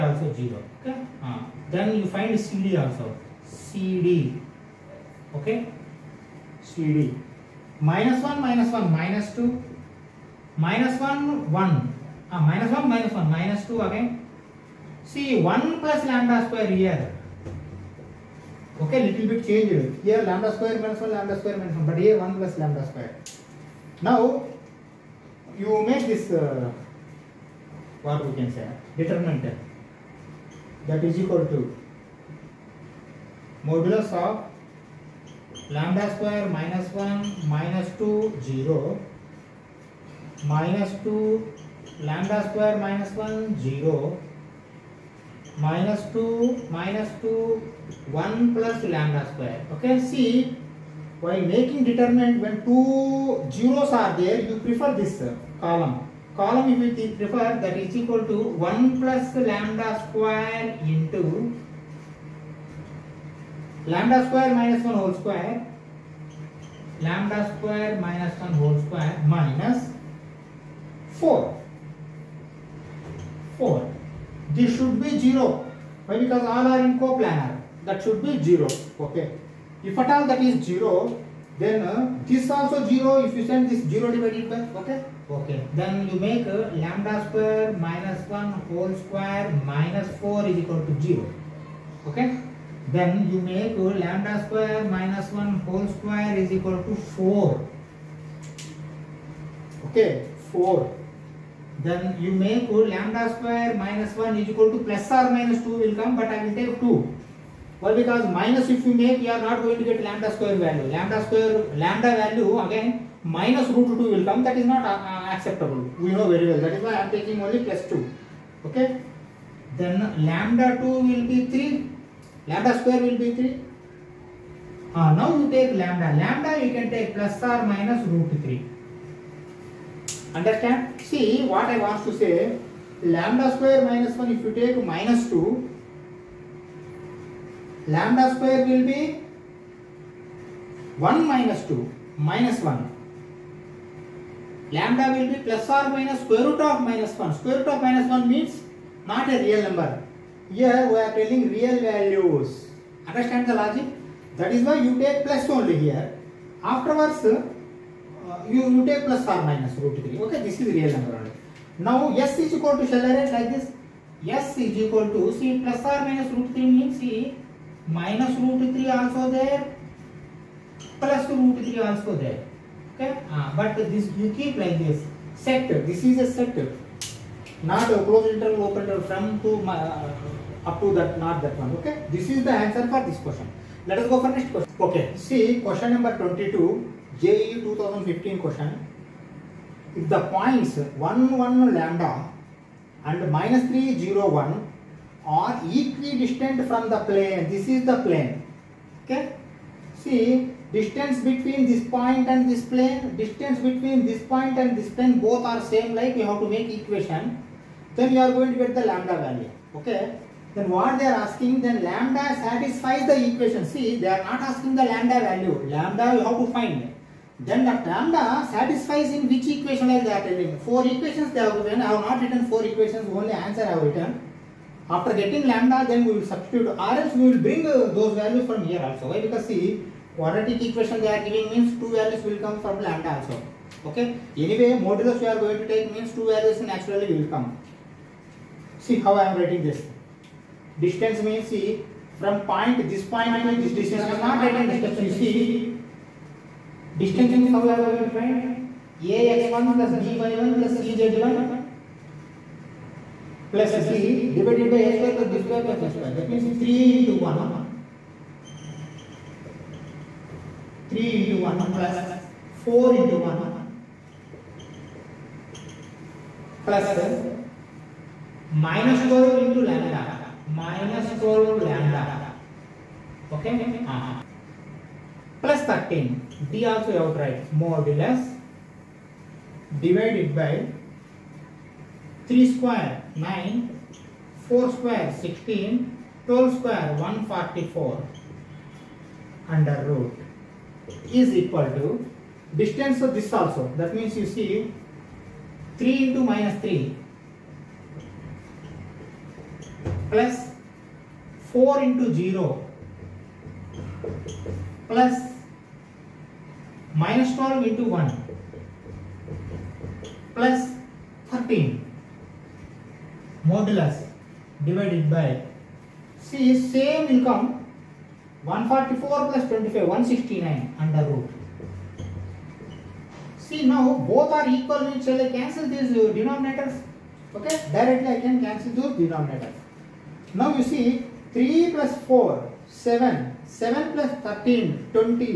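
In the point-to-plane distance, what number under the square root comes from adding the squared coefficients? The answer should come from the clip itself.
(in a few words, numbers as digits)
169.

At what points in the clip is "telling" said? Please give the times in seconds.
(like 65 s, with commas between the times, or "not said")
151 s, 220 s.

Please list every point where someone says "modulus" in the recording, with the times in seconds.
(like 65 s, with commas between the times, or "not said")
33 s, 234 s, 277 s, 313 s.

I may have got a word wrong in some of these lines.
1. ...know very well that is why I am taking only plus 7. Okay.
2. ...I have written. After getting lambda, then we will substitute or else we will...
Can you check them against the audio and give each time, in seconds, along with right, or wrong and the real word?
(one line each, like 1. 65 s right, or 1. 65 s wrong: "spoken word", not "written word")
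1. 116 s wrong: "2", not "7"
2. 223 s right.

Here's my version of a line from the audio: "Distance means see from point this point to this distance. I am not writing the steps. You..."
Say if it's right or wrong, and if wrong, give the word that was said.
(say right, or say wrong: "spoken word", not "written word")
right.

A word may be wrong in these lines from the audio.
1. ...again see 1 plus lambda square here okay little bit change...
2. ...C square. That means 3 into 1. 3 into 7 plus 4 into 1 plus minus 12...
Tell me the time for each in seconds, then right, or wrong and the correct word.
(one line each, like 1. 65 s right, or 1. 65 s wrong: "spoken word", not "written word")
1. 13 s right
2. 255 s wrong: "1", not "7".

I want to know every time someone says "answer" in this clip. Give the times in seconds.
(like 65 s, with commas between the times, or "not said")
182 s, 223 s.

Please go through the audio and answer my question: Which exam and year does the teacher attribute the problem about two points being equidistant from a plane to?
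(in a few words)
JEE 2015.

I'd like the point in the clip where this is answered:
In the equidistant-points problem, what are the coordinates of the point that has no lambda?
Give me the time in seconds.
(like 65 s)
193 s.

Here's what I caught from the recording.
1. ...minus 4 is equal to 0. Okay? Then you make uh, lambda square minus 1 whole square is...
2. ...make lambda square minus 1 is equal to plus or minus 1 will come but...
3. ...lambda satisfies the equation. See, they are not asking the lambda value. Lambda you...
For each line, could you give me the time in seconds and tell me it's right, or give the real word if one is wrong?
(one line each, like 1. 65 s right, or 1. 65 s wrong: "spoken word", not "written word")
1. 89 s right
2. 102 s wrong: "2", not "1"
3. 211 s right.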